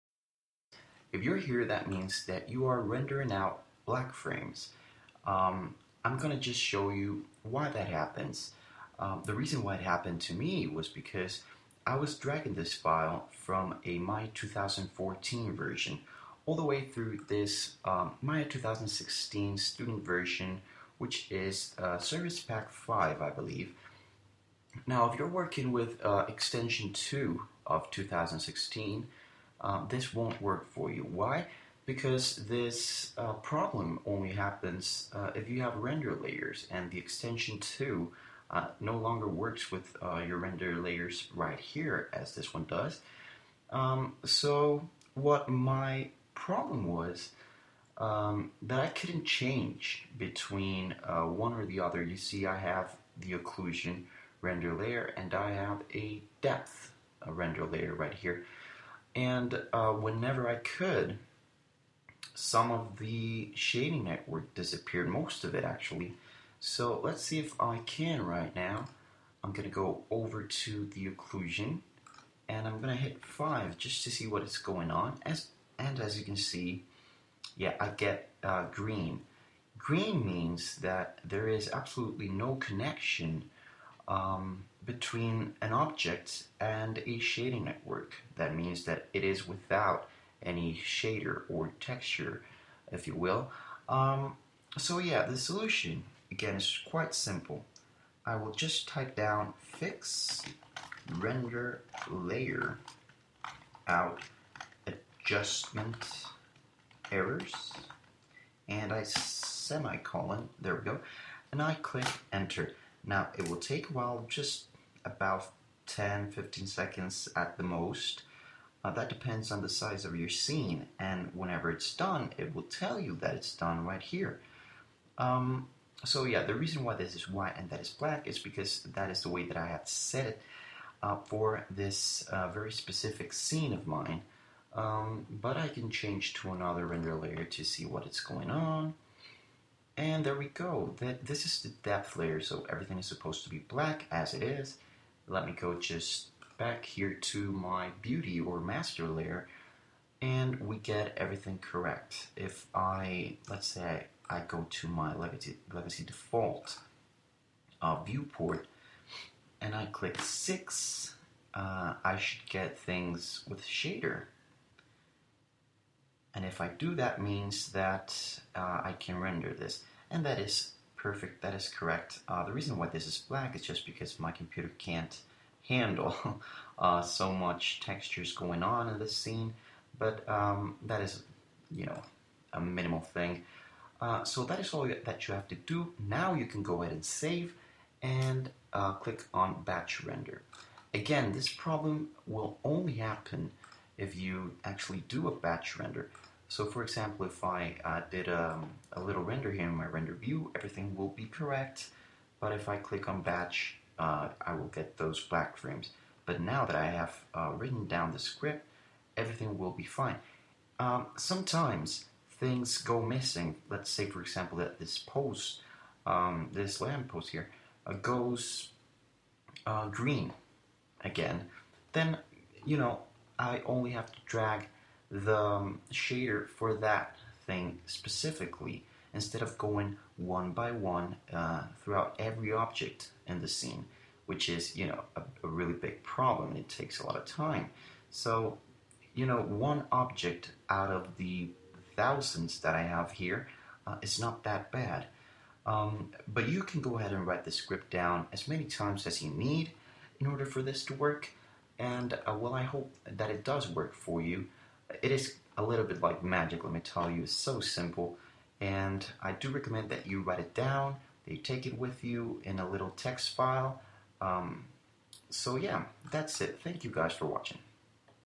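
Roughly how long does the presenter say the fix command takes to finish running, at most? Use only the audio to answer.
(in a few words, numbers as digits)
10-15 seconds.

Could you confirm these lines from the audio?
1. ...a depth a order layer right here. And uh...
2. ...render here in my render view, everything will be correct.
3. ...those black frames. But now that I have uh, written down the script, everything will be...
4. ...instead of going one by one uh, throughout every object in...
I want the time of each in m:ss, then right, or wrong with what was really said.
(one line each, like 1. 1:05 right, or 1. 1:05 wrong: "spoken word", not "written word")
1. 0:55 wrong: "render", not "order"
2. 3:19 right
3. 3:24 right
4. 3:49 right.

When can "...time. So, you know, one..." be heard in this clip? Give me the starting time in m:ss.
3:57.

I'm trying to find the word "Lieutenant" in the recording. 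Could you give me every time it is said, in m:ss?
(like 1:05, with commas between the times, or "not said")
not said.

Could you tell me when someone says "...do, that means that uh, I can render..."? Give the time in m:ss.
2:46.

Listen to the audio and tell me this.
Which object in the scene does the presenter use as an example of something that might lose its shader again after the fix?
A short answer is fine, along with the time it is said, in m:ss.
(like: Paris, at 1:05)
Lamppost, at 3:36.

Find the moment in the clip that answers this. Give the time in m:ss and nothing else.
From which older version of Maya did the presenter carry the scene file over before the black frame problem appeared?
0:13.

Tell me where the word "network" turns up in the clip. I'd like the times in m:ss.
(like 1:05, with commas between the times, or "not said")
1:04, 1:27.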